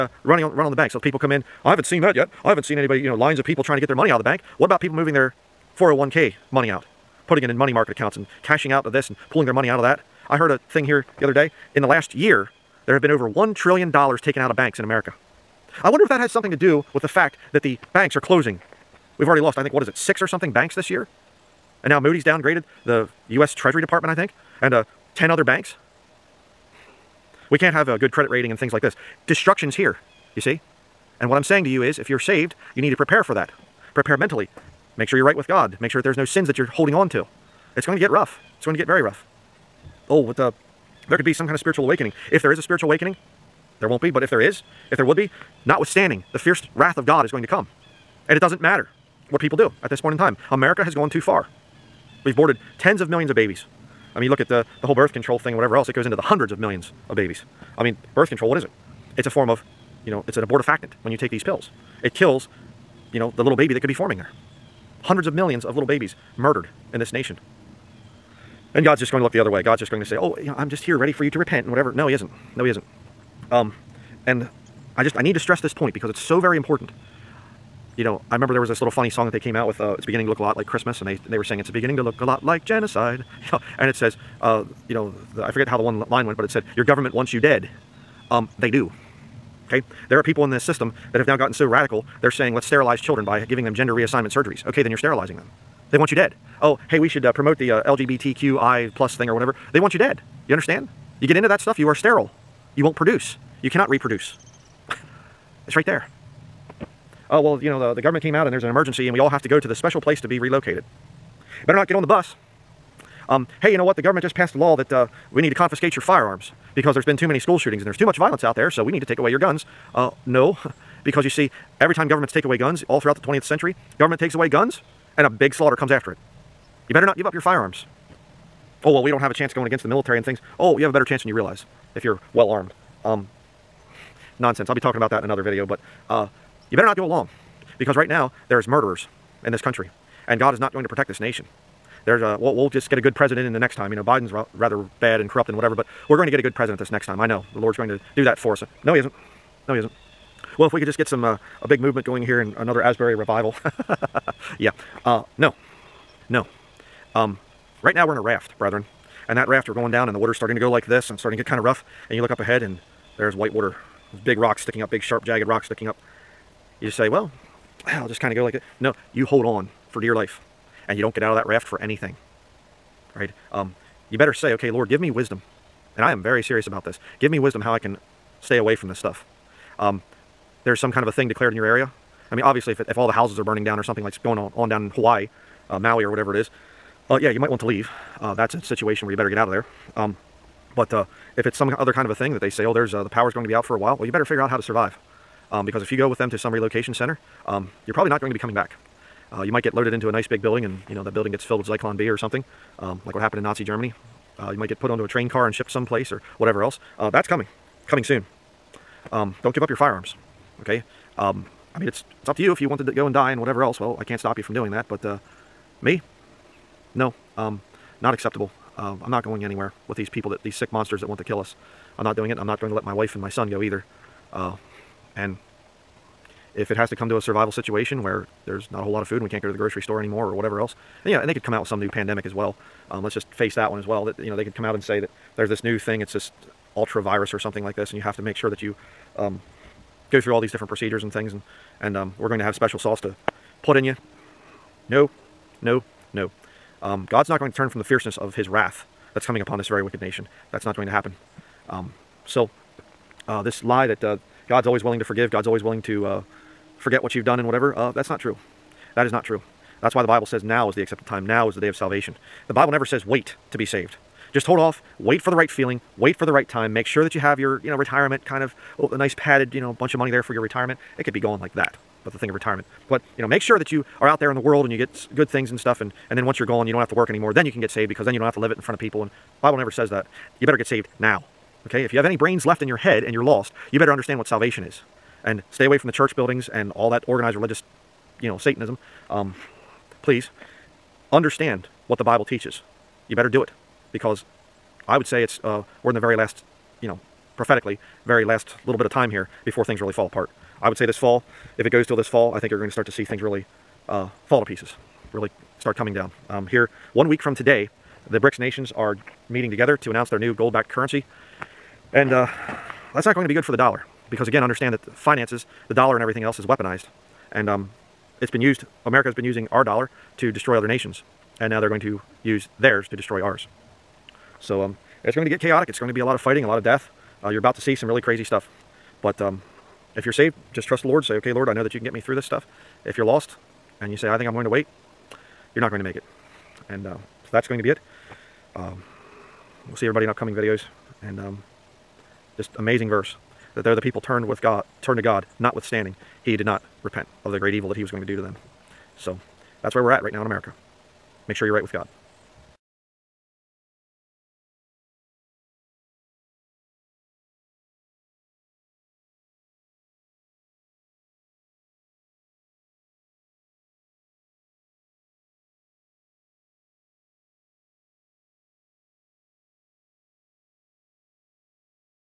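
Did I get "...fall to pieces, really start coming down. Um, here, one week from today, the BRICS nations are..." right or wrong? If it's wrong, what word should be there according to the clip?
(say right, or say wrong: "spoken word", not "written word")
right.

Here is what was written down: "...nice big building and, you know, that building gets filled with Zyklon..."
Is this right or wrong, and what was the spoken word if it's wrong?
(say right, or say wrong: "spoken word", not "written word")
right.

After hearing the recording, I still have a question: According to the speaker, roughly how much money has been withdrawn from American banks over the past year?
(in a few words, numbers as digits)
1 trillion dollars.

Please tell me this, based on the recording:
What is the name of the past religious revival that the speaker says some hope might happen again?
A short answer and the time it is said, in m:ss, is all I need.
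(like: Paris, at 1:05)
Asbury revival, at 2:32.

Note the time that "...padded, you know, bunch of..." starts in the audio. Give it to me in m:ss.
4:29.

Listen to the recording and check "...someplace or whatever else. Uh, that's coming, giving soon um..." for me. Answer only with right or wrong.
wrong.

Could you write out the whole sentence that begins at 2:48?
No, you hold on for dear life and you don't get out of that raft for anything.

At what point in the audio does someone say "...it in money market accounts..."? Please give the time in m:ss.
0:07.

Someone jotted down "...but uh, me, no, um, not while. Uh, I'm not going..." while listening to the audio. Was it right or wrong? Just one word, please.
wrong.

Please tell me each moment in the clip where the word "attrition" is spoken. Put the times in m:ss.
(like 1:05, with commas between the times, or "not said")
not said.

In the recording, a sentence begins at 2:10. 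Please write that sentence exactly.
Oh, you have a better chance than you realize if you're well armed.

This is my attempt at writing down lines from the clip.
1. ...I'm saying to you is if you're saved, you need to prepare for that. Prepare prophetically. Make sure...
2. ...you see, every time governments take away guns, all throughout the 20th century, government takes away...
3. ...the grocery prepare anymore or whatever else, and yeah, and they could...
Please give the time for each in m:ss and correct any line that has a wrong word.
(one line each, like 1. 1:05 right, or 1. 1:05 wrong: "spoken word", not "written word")
1. 0:31 wrong: "mentally", not "prophetically"
2. 2:01 right
3. 3:49 wrong: "store", not "prepare".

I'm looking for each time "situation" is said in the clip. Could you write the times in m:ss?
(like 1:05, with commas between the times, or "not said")
3:08, 3:47.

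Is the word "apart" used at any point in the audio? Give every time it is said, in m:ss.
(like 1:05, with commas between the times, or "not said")
5:00.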